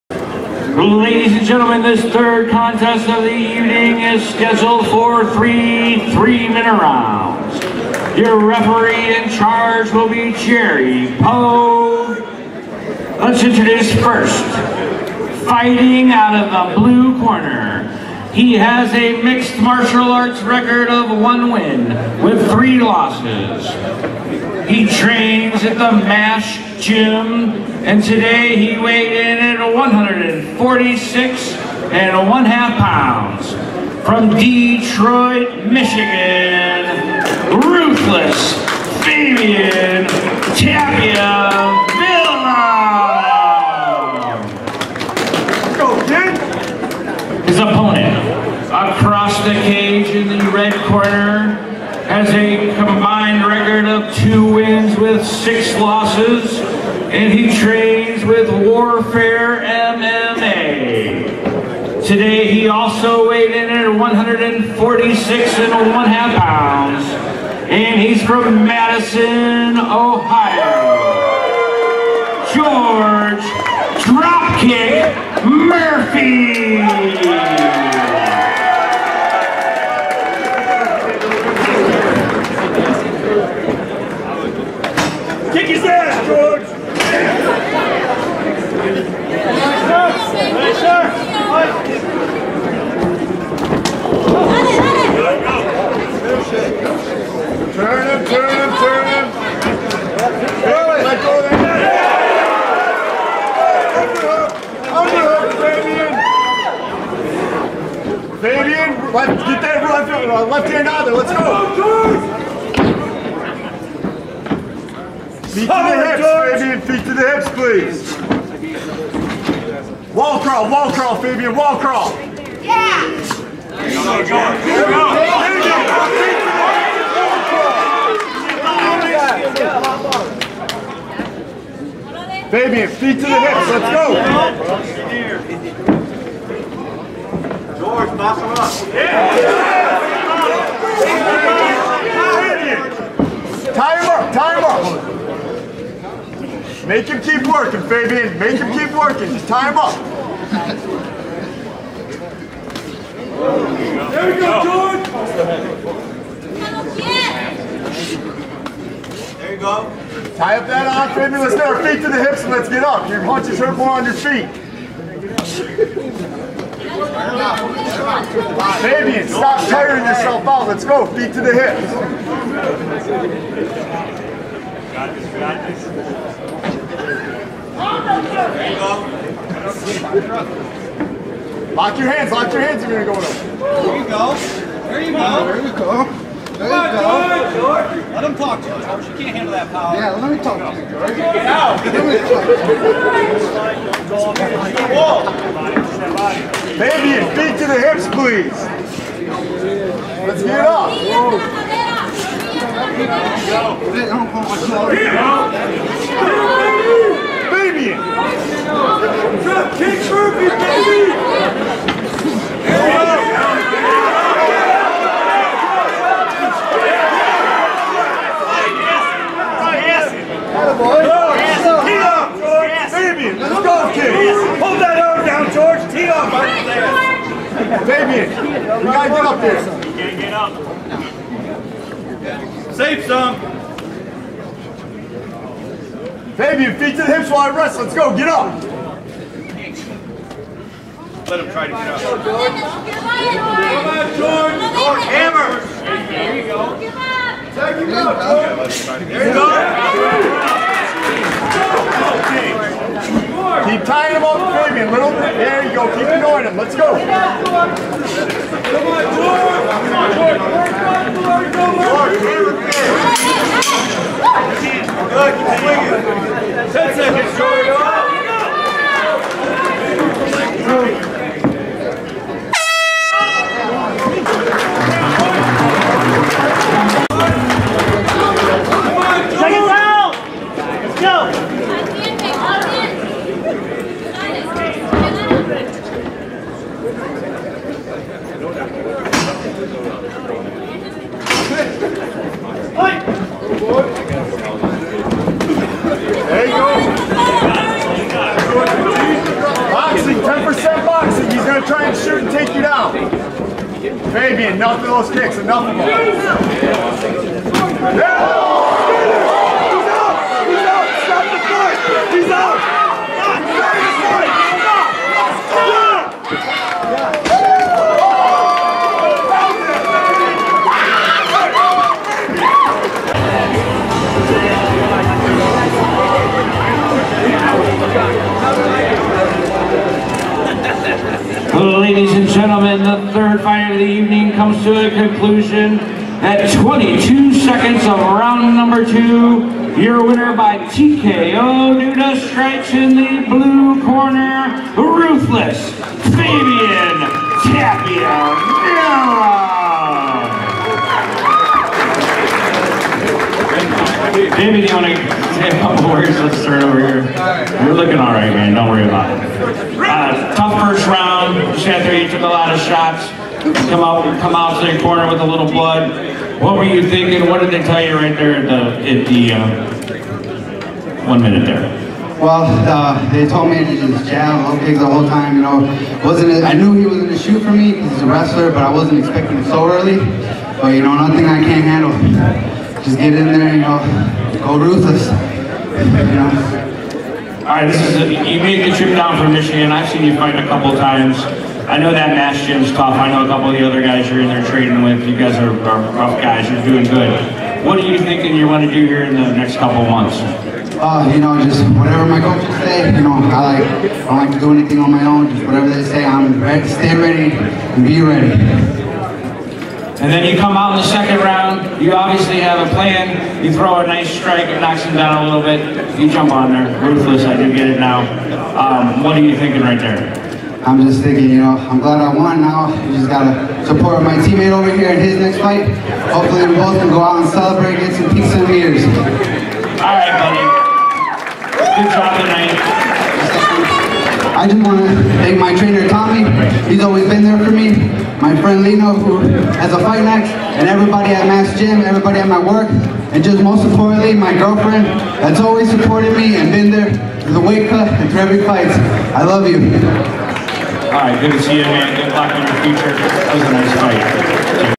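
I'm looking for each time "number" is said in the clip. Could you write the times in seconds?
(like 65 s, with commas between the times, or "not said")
338 s.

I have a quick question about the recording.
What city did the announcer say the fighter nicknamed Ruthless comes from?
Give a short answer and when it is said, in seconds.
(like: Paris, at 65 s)
Detroit, at 34 s.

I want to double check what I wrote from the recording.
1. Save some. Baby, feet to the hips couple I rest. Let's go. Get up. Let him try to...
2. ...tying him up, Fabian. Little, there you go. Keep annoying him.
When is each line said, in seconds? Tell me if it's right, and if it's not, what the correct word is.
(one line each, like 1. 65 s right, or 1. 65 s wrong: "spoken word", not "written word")
1. 232 s wrong: "while", not "couple"
2. 253 s right.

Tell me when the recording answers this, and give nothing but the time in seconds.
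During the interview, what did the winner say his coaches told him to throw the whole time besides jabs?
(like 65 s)
374 s.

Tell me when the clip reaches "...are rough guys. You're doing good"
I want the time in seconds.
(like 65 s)
395 s.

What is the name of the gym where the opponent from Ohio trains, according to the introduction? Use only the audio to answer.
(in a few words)
Warfare MMA.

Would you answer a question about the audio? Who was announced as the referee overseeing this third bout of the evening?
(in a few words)
Jerry Poe.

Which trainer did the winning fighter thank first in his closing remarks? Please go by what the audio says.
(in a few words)
Tommy.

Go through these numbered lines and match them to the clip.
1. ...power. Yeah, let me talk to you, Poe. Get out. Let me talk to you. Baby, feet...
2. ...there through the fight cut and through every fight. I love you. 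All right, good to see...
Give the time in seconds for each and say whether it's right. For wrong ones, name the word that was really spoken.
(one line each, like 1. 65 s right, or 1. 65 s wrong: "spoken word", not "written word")
1. 189 s wrong: "George", not "Poe"
2. 446 s wrong: "weight", not "fight".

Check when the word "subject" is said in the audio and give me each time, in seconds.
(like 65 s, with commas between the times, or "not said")
not said.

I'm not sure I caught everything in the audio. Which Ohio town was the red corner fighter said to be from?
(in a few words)
Madison.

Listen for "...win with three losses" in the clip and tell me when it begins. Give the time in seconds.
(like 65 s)
21 s.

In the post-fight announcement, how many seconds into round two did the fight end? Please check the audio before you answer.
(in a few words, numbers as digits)
22.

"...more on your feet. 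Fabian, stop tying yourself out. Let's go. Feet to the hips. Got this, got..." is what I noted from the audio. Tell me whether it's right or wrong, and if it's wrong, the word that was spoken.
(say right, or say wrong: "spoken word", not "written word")
wrong: "tiring", not "tying".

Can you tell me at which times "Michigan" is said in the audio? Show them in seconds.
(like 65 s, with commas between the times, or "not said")
35 s, 389 s.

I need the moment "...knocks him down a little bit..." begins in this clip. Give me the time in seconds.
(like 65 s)
414 s.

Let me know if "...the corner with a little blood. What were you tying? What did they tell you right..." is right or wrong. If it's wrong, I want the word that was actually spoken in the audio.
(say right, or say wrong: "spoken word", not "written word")
wrong: "thinking", not "tying".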